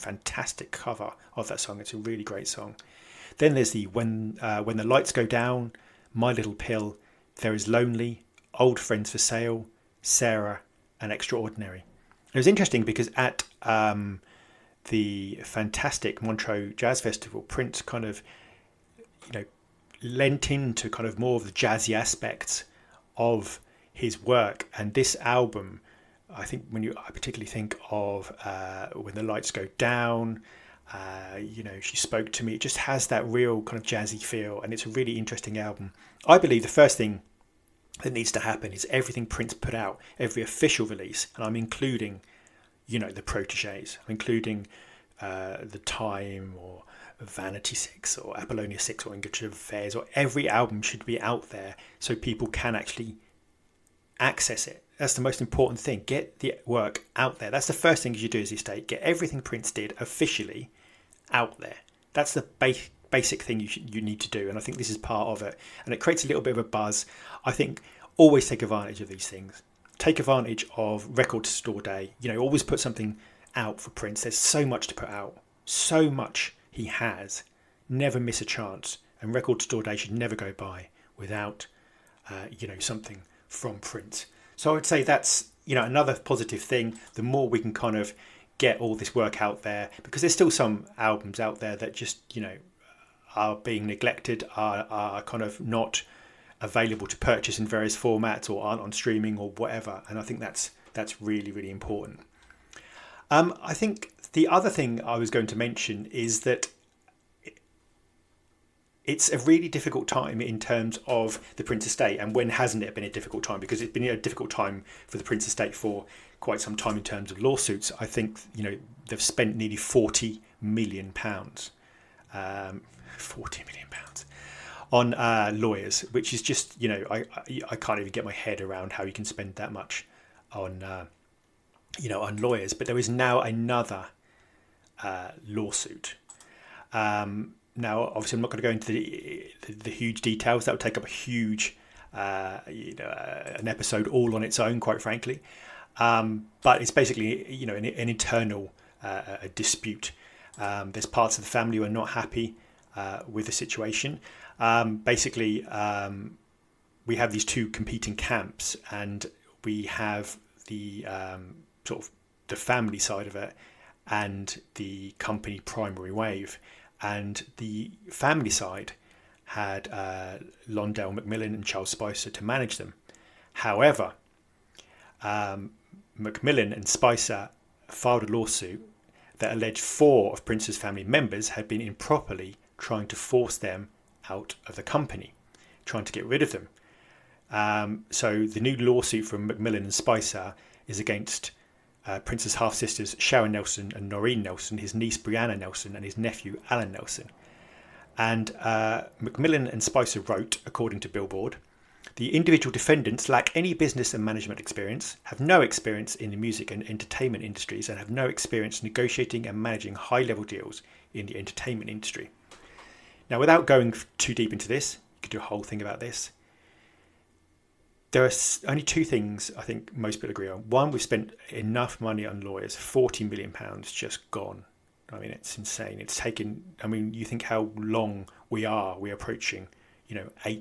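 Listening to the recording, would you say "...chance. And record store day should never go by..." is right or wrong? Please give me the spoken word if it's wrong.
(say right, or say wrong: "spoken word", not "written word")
right.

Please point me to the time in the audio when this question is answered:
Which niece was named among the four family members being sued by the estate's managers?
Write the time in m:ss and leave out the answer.
3:15.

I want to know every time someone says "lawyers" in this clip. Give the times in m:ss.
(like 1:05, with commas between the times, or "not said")
2:05, 2:12, 3:42.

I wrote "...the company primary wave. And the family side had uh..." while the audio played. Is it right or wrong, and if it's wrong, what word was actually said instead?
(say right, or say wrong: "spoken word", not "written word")
right.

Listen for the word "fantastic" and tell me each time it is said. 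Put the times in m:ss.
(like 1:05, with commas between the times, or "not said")
0:15.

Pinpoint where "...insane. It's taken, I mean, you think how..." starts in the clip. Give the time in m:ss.
3:45.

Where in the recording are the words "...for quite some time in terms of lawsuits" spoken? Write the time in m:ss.
1:55.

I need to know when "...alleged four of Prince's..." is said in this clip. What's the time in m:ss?
2:59.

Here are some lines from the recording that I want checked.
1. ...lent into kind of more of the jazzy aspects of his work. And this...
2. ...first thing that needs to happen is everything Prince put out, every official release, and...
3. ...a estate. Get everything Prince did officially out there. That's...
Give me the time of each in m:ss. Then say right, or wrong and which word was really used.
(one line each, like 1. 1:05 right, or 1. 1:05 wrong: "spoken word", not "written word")
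1. 0:20 right
2. 0:36 right
3. 0:58 right.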